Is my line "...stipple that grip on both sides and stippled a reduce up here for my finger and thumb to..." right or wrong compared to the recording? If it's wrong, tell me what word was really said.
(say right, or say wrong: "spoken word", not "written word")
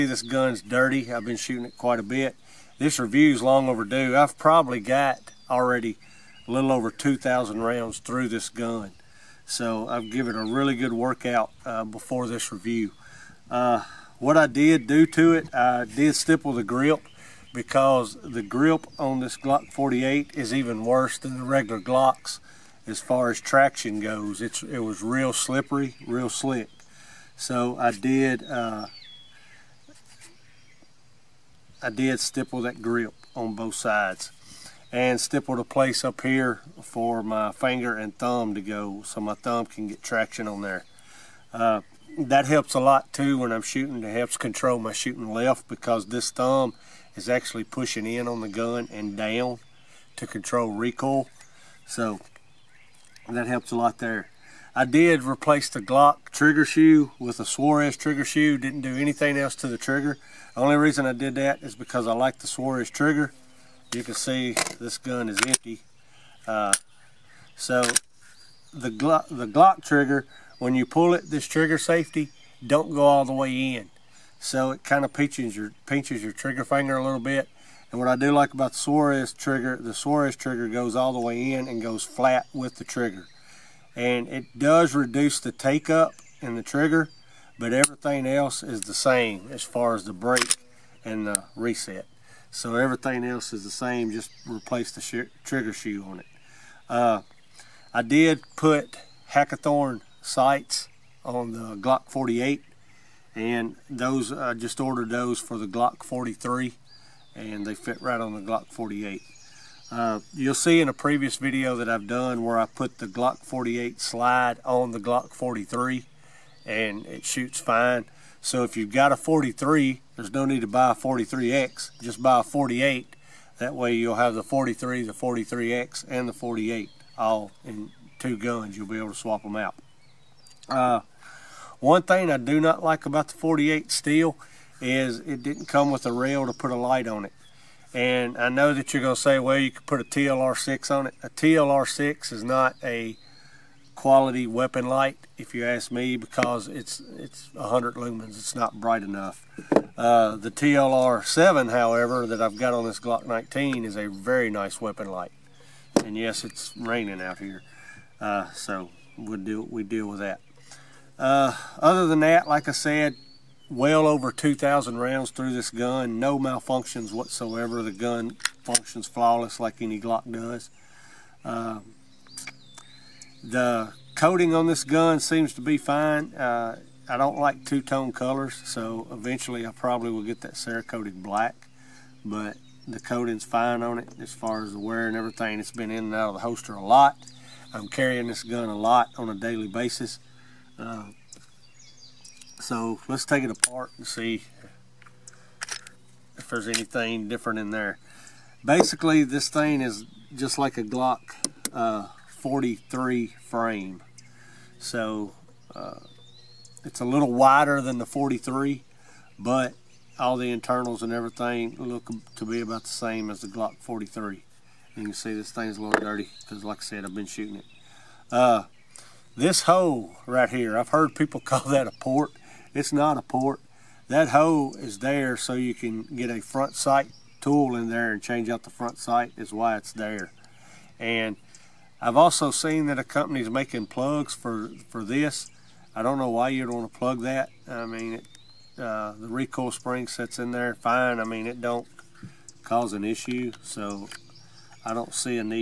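wrong: "place", not "reduce".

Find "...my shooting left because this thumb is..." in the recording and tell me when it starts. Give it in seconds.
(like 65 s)
44 s.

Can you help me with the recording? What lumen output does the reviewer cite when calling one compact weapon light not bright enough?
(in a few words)
100 lumens.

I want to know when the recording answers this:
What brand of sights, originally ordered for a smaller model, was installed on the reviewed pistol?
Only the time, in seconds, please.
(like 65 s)
99 s.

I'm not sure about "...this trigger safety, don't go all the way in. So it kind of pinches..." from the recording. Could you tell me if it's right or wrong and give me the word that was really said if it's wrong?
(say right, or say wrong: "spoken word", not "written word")
right.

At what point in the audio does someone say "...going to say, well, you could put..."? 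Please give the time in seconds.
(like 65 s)
139 s.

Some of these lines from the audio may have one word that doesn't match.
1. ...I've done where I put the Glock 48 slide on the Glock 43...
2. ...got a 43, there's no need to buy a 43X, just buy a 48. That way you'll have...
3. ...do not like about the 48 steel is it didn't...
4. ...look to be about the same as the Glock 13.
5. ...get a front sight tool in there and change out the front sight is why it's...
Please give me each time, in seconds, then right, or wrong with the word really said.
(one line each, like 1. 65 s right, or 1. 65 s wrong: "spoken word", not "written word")
1. 111 s right
2. 118 s right
3. 132 s right
4. 211 s wrong: "43", not "13"
5. 226 s right.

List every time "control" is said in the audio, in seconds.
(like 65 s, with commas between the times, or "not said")
44 s, 50 s.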